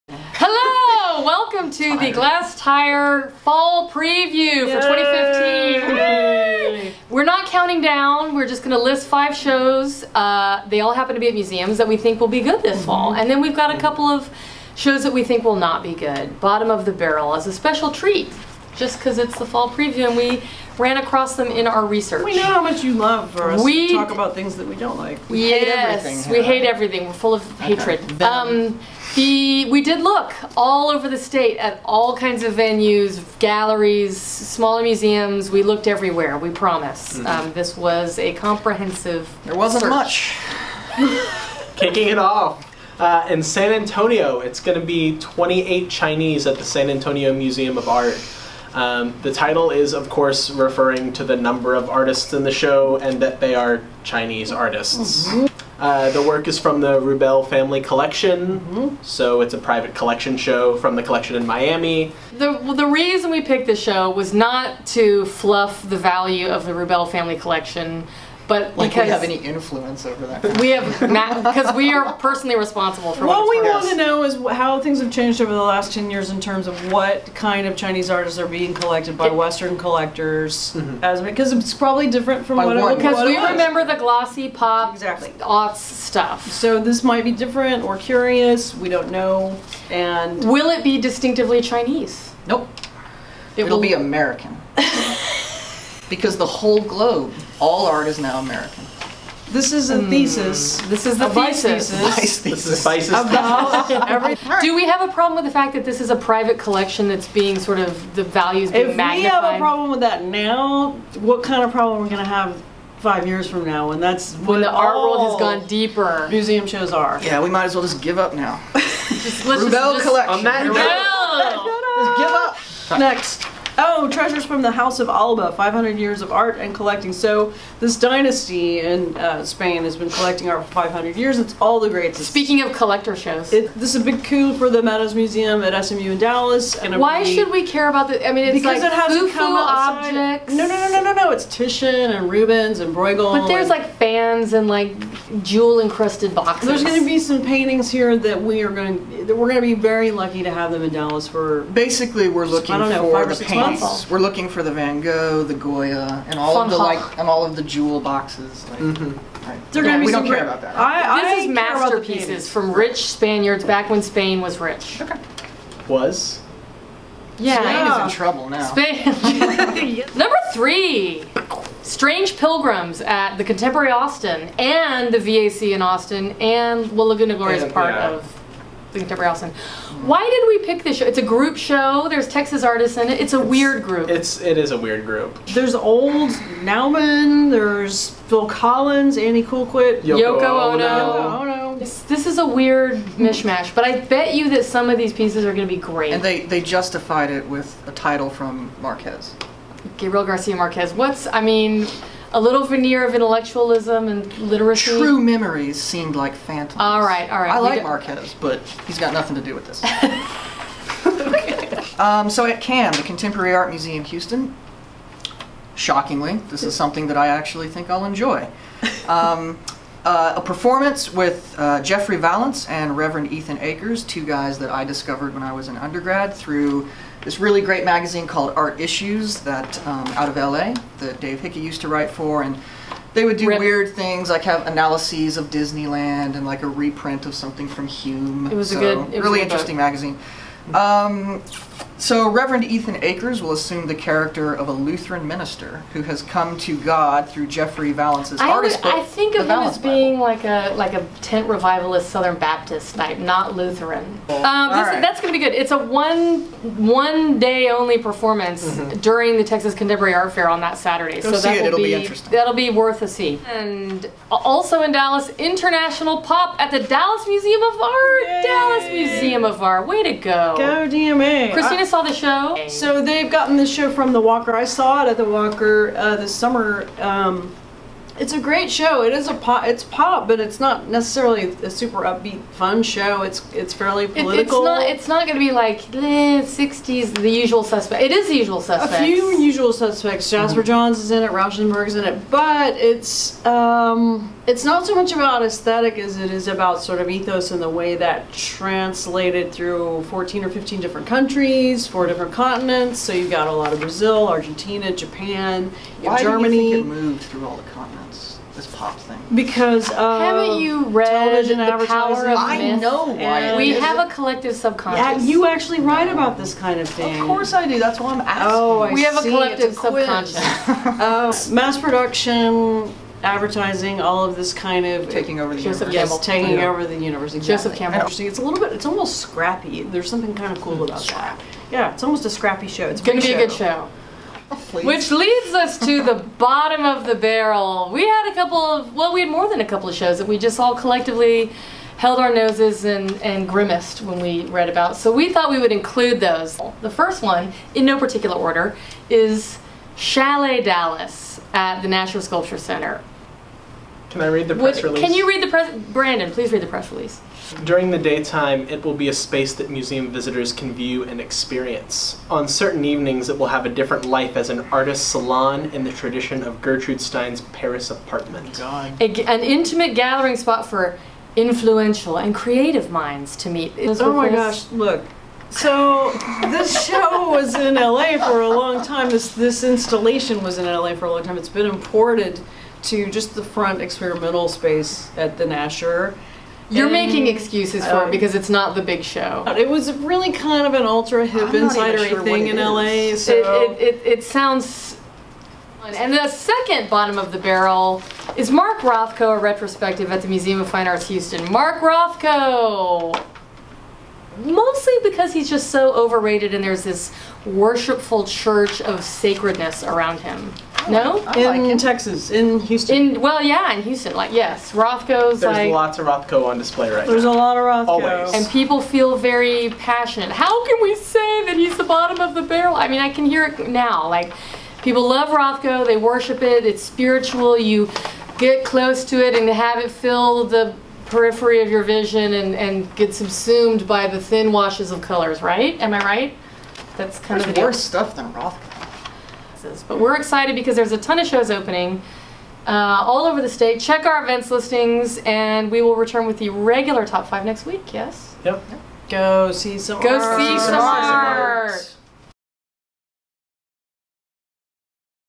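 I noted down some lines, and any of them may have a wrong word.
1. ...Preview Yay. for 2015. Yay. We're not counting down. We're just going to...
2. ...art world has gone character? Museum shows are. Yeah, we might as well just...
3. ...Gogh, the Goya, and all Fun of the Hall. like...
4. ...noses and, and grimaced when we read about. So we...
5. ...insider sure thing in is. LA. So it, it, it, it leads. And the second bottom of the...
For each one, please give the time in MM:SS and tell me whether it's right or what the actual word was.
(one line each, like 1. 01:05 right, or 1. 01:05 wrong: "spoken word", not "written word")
1. 00:03 right
2. 01:54 wrong: "deeper", not "character"
3. 02:35 right
4. 05:42 right
5. 06:31 wrong: "sounds", not "leads".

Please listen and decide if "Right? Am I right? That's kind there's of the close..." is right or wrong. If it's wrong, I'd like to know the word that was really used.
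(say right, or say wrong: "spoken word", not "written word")
wrong: "worse", not "close".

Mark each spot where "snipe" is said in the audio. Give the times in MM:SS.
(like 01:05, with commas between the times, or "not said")
not said.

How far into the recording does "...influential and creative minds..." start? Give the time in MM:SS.
06:11.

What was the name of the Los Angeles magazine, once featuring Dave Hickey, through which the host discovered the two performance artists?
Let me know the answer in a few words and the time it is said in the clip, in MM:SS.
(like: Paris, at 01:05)
Art Issues, at 03:48.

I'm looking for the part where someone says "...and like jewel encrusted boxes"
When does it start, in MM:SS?
02:24.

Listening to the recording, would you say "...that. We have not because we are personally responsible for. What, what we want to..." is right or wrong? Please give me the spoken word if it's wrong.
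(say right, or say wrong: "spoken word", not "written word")
right.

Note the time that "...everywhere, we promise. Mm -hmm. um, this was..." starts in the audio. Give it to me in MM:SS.
00:35.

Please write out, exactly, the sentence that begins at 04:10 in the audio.
like a like a tent revivalist Southern Baptist type, not Lutheran.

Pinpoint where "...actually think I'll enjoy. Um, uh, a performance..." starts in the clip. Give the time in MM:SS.
03:37.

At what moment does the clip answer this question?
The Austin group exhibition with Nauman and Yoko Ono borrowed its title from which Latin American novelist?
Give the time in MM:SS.
03:19.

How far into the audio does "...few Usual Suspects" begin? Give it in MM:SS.
04:49.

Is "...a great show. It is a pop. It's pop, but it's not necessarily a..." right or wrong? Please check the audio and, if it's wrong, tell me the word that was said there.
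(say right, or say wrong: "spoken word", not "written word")
right.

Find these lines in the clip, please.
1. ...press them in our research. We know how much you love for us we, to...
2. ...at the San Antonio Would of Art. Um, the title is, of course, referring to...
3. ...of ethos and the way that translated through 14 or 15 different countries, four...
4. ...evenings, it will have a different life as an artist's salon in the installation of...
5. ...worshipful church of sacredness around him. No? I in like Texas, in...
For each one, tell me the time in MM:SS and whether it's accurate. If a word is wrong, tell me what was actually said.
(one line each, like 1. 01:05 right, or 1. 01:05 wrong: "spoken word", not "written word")
1. 00:20 wrong: "across", not "press"
2. 00:46 wrong: "Museum", not "Would"
3. 04:57 right
4. 06:02 wrong: "tradition", not "installation"
5. 06:47 right.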